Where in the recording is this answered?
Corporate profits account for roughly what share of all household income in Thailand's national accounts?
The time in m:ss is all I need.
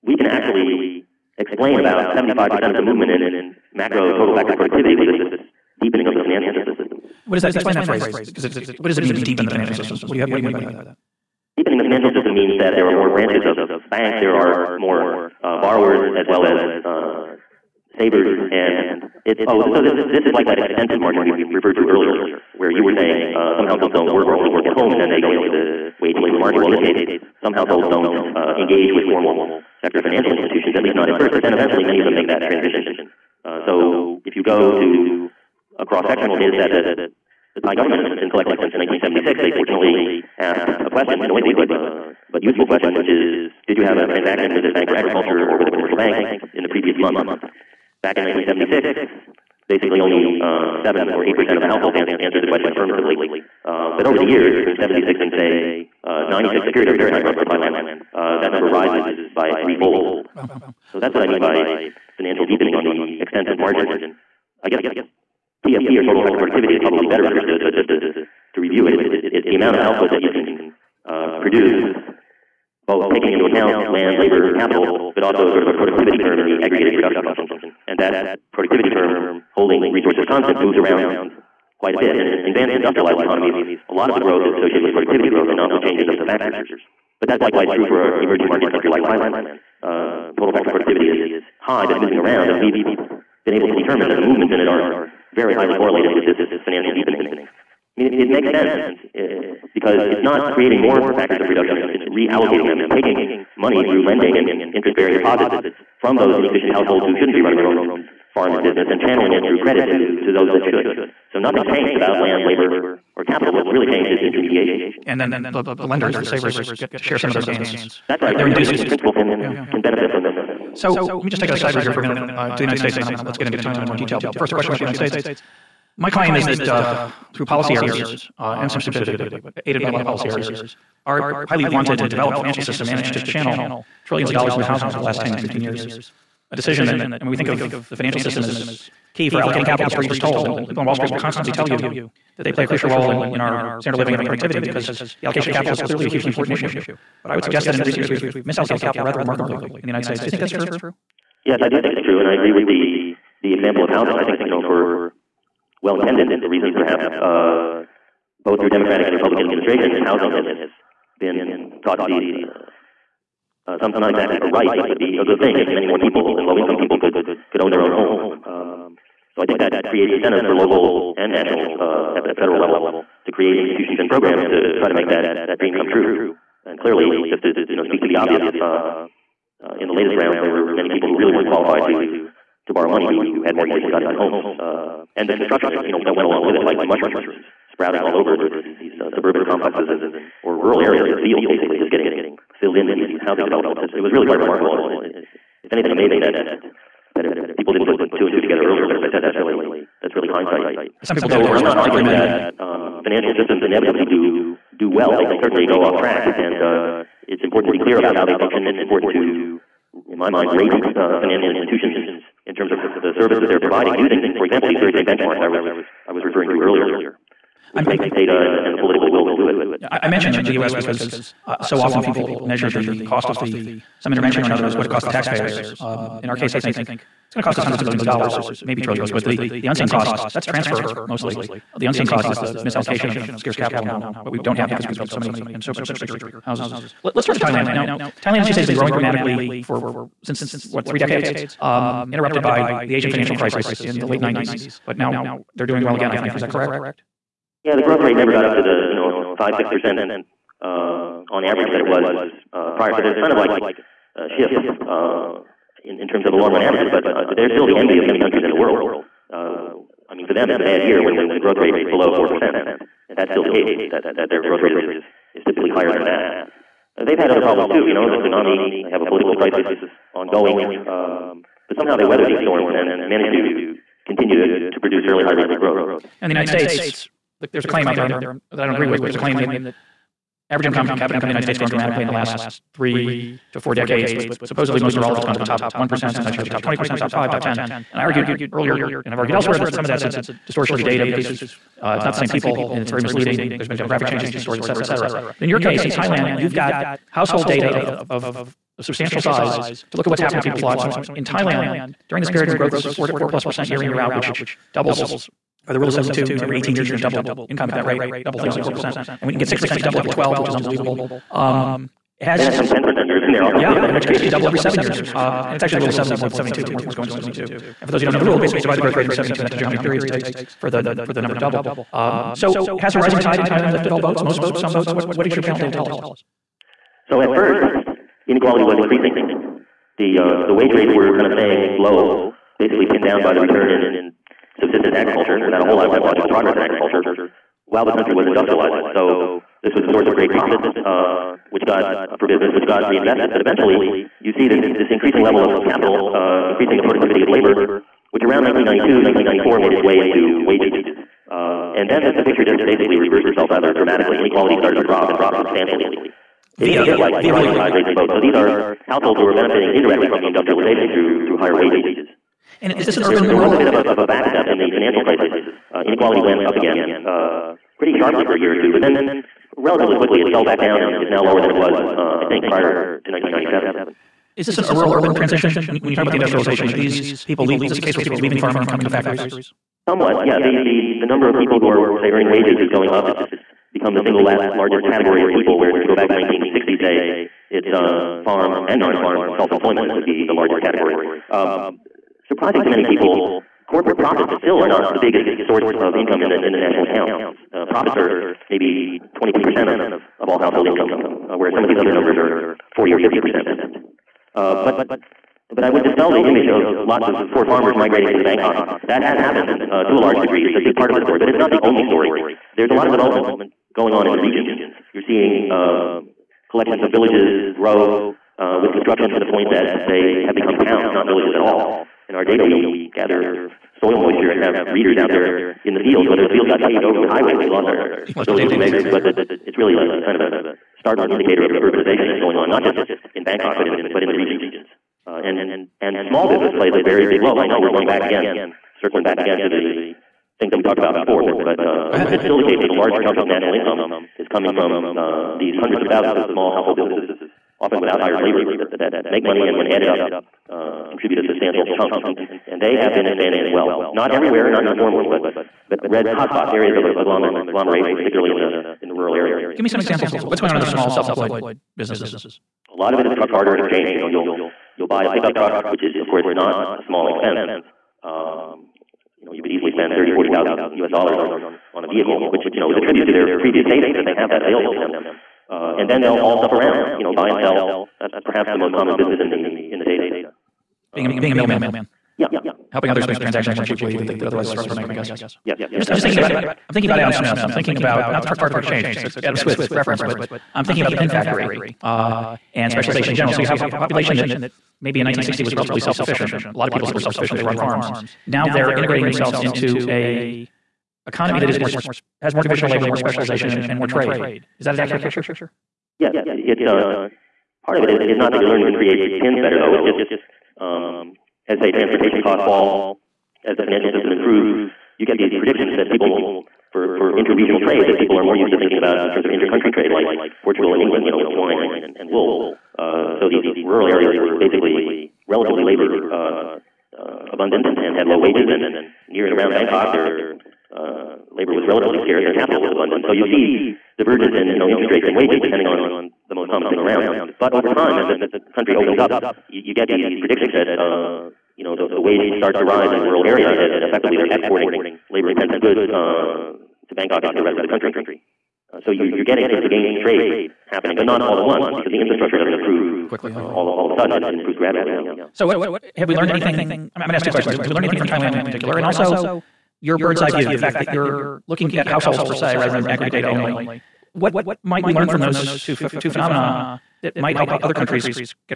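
6:39.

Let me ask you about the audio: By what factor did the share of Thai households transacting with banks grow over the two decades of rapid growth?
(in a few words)
Threefold.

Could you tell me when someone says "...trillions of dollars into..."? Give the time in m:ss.
2:14.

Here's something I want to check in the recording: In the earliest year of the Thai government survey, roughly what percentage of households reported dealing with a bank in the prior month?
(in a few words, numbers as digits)
7 or 8 percent.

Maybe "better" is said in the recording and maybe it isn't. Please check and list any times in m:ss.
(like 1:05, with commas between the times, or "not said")
1:07, 8:29.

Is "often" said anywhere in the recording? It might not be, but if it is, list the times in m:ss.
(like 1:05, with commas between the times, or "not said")
3:41, 7:27.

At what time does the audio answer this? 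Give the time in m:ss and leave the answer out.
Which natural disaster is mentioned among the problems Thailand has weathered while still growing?
4:28.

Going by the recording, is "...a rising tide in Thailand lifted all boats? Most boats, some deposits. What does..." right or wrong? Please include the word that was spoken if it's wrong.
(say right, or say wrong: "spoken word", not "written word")
wrong: "boats", not "deposits".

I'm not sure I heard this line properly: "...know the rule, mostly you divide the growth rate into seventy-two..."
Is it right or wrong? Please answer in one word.
wrong.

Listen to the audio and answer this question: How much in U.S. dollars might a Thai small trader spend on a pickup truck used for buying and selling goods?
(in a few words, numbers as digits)
$30,000-$40,000.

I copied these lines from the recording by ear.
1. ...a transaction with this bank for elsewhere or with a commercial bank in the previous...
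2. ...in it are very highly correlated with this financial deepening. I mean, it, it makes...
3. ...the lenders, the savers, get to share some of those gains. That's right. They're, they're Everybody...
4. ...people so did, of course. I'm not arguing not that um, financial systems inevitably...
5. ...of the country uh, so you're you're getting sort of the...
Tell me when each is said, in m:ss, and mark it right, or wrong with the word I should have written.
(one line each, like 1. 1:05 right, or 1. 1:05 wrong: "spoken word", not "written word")
1. 0:43 wrong: "agriculture", not "elsewhere"
2. 1:34 right
3. 1:55 right
4. 3:21 right
5. 9:07 right.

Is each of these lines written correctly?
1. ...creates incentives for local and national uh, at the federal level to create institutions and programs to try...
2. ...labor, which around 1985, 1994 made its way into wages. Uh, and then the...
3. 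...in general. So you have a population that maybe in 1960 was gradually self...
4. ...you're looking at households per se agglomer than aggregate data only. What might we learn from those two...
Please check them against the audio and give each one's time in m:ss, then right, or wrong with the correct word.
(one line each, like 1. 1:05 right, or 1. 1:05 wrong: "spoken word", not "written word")
1. 2:49 right
2. 5:47 wrong: "1992", not "1985"
3. 8:13 wrong: "relatively", not "gradually"
4. 9:20 wrong: "rather", not "agglomer".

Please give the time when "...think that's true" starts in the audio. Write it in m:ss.
2:30.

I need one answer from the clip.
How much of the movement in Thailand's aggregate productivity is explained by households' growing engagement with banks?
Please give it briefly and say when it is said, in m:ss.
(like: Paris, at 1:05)
75%, at 0:02.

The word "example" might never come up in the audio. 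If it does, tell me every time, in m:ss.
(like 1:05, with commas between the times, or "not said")
2:33, 3:34, 7:39.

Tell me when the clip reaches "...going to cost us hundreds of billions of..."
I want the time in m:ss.
3:47.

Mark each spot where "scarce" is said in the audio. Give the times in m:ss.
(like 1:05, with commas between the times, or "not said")
3:53, 8:52.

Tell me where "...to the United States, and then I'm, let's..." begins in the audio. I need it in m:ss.
2:02.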